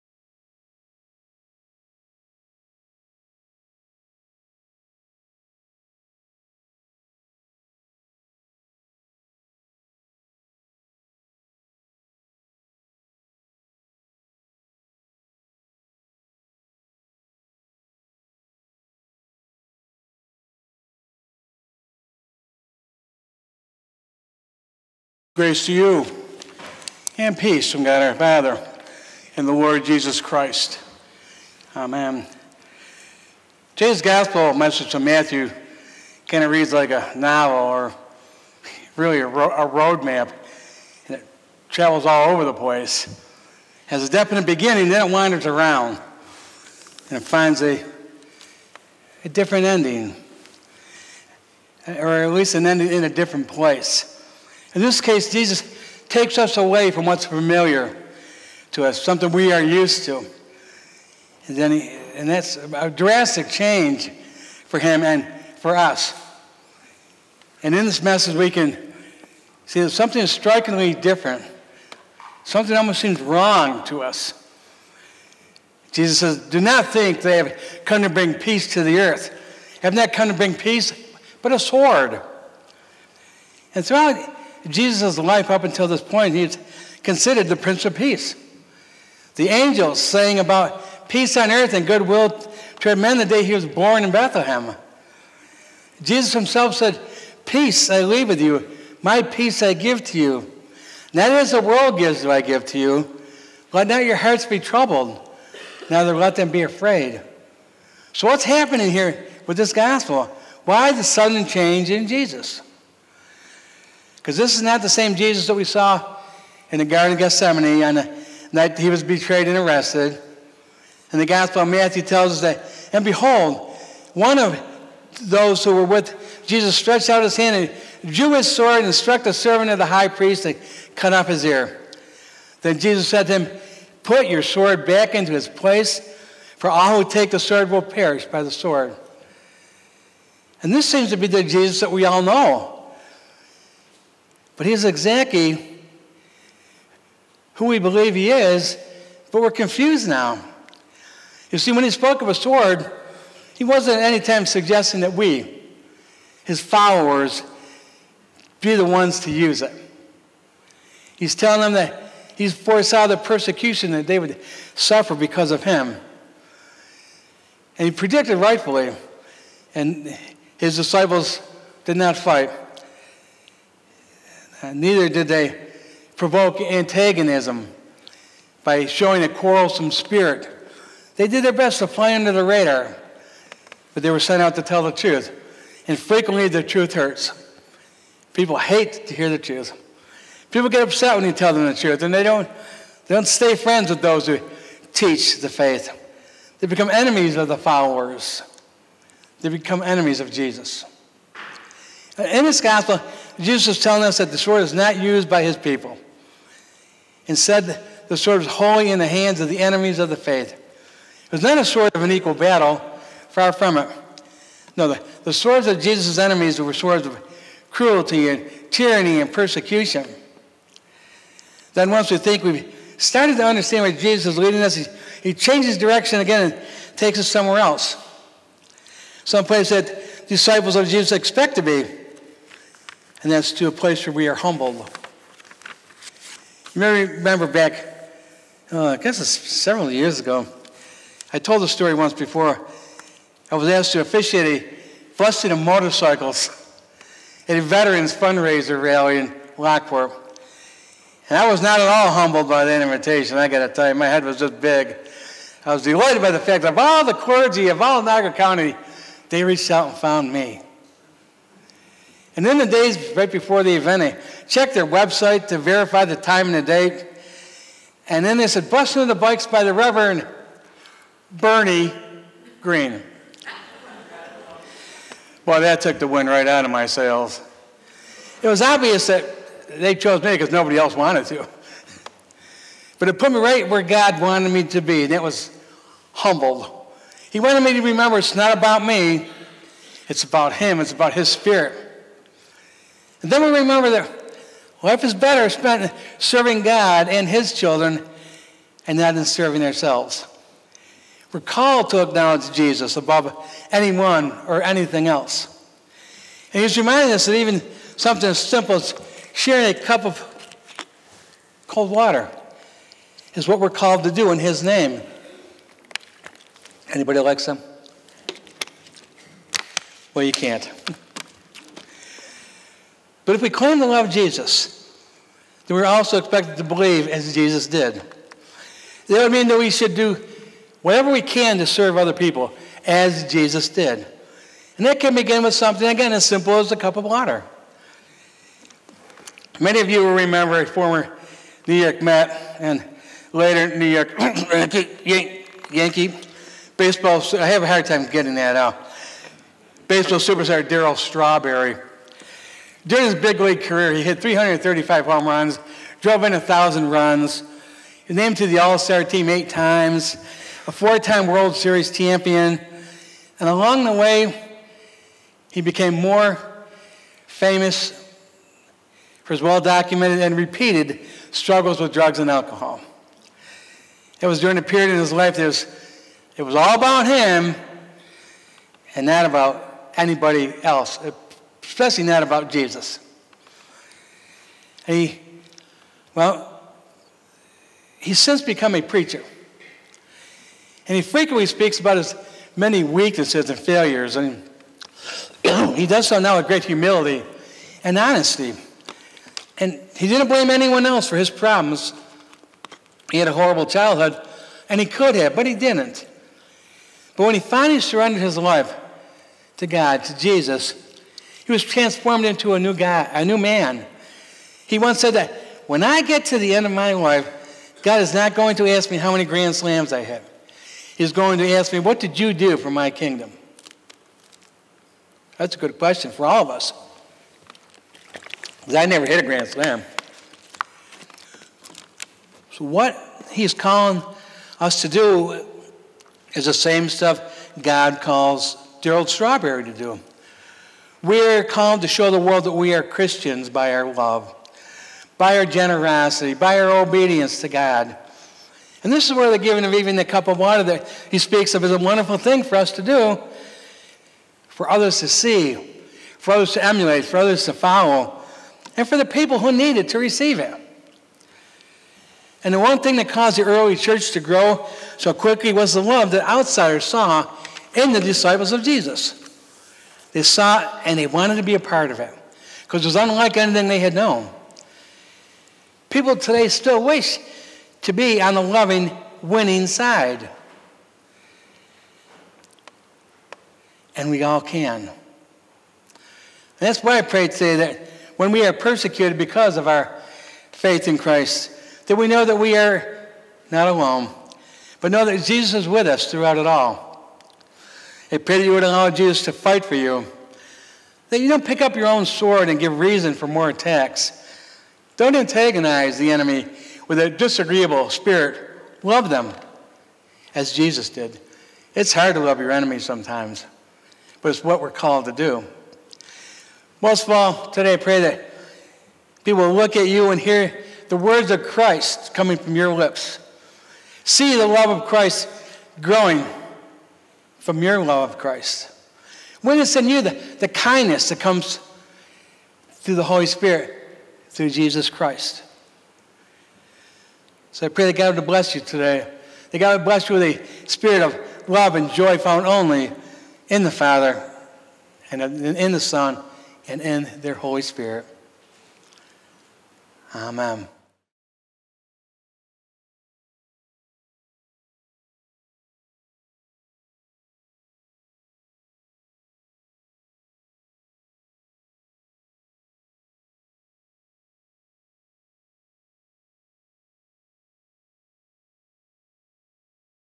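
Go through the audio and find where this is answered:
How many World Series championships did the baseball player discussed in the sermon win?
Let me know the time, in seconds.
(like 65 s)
360 s.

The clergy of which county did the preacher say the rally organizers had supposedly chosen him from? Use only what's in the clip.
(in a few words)
Niagara County.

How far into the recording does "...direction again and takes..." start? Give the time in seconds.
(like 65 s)
225 s.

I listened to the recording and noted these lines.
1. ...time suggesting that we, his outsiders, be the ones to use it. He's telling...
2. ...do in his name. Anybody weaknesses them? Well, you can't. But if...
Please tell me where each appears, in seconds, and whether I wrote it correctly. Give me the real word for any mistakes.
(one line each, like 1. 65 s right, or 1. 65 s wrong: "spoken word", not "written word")
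1. 154 s wrong: "followers", not "outsiders"
2. 314 s wrong: "likes", not "weaknesses".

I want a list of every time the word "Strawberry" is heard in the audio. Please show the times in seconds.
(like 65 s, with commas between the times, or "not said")
350 s, 439 s.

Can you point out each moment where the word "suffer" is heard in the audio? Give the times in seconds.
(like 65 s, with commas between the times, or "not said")
164 s.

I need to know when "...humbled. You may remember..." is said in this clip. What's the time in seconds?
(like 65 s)
234 s.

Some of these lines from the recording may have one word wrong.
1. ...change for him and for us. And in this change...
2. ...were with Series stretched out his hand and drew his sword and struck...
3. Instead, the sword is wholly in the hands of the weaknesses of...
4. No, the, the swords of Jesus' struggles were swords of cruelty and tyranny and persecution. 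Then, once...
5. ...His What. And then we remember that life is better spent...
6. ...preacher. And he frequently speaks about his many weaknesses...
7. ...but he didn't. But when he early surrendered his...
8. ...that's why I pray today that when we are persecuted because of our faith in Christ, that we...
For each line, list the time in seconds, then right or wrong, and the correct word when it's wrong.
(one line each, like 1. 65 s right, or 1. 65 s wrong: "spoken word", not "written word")
1. 63 s wrong: "message", not "change"
2. 125 s wrong: "Jesus", not "Series"
3. 207 s wrong: "enemies", not "weaknesses"
4. 214 s wrong: "enemies", not "struggles"
5. 291 s wrong: "Spirit", not "What"
6. 388 s right
7. 405 s wrong: "finally", not "early"
8. 486 s right.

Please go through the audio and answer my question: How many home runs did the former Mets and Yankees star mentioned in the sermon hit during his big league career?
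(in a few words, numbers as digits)
335.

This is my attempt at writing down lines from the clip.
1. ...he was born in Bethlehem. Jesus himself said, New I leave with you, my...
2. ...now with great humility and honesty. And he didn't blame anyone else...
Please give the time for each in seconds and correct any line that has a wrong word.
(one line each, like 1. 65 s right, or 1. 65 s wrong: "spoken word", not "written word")
1. 93 s wrong: "Peace", not "New"
2. 396 s right.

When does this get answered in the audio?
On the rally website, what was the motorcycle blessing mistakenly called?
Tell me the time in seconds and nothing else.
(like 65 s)
268 s.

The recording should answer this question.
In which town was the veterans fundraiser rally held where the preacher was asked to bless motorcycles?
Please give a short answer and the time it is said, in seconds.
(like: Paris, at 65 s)
Lockport, at 249 s.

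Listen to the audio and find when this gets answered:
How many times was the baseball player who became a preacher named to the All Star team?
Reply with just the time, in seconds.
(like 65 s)
359 s.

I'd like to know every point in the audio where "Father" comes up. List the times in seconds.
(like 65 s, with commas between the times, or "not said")
28 s, 543 s.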